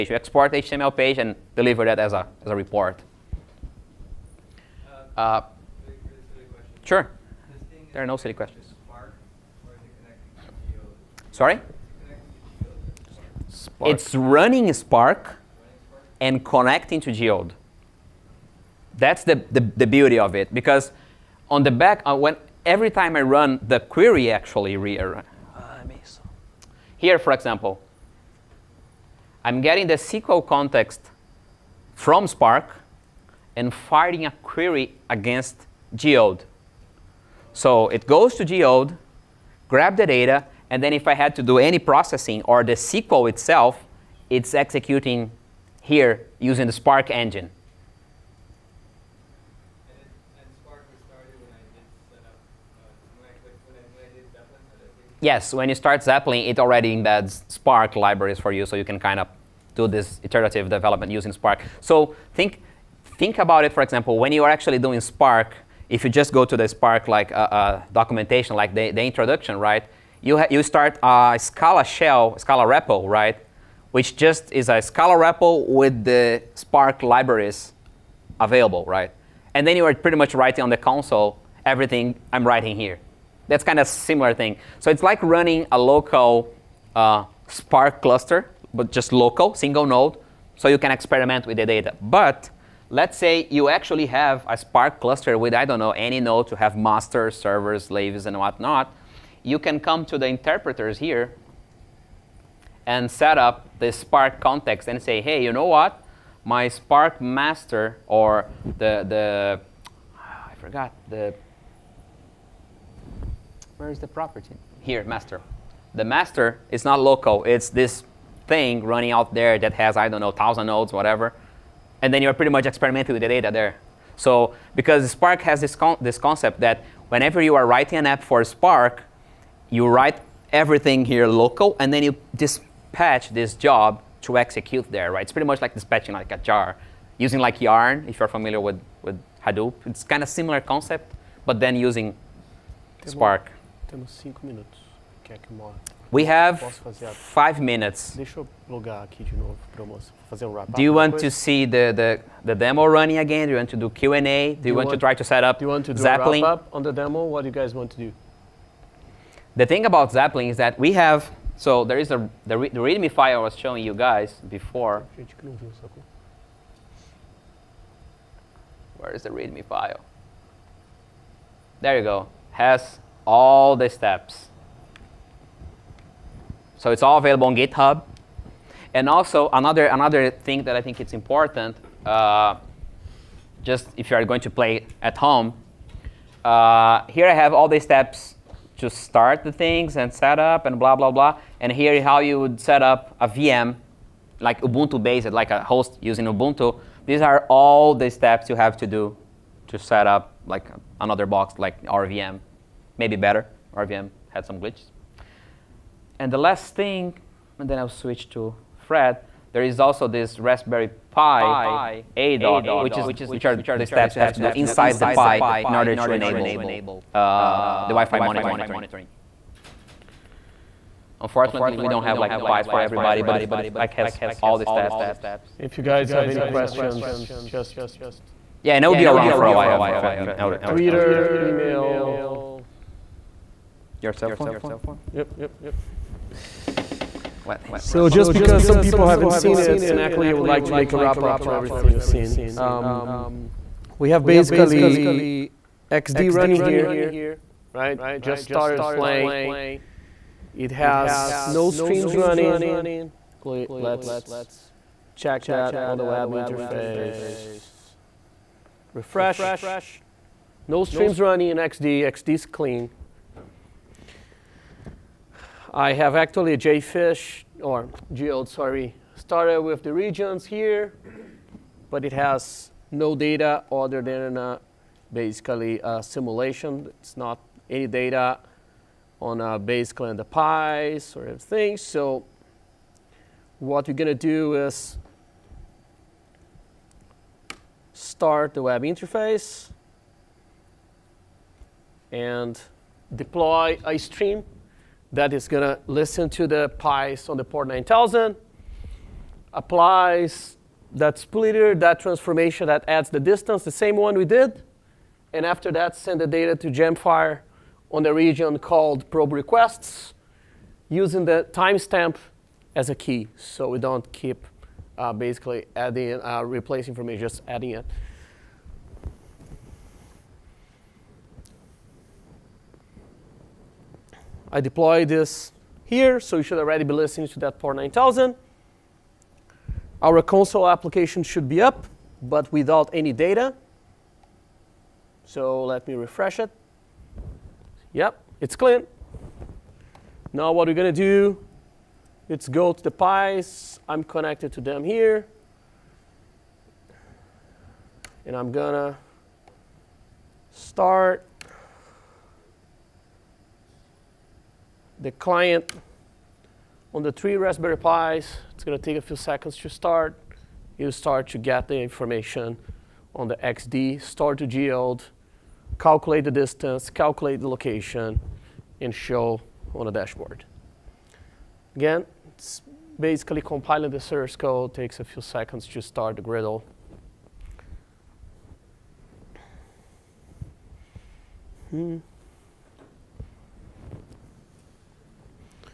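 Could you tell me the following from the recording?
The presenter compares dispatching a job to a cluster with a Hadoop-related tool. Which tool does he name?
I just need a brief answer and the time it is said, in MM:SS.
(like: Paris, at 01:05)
Yarn, at 02:17.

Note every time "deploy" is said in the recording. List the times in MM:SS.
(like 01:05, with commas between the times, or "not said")
04:53, 05:24.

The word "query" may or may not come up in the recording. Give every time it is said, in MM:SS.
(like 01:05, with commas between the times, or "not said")
00:23, 00:34.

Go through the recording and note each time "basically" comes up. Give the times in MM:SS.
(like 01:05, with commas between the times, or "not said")
04:04, 04:35, 04:39, 05:15, 06:12.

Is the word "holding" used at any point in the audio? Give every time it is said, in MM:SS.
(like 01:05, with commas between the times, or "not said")
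not said.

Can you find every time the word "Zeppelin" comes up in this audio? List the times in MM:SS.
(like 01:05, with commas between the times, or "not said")
00:56, 02:36, 02:40.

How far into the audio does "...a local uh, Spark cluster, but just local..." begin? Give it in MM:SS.
01:25.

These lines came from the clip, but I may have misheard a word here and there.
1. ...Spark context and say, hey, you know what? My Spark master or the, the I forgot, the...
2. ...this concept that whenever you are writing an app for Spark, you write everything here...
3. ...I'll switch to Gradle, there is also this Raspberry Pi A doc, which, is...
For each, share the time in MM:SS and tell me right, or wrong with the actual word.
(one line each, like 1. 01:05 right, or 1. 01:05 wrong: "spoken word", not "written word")
1. 01:43 right
2. 02:06 right
3. 03:27 wrong: "Fred", not "Gradle".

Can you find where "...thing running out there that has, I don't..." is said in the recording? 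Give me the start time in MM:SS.
01:58.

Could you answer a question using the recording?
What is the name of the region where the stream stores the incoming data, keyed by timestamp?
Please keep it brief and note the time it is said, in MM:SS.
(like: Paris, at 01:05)
probe requests, at 05:09.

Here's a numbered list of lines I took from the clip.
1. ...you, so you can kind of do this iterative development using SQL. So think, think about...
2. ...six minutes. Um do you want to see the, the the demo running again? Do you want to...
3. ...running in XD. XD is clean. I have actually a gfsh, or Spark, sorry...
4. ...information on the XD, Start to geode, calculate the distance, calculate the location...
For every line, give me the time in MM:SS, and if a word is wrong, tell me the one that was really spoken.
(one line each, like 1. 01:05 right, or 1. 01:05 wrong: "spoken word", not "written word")
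1. 00:58 wrong: "Spark", not "SQL"
2. 02:27 wrong: "five", not "six"
3. 04:21 wrong: "Geode", not "Spark"
4. 06:01 right.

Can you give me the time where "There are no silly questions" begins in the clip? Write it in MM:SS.
00:07.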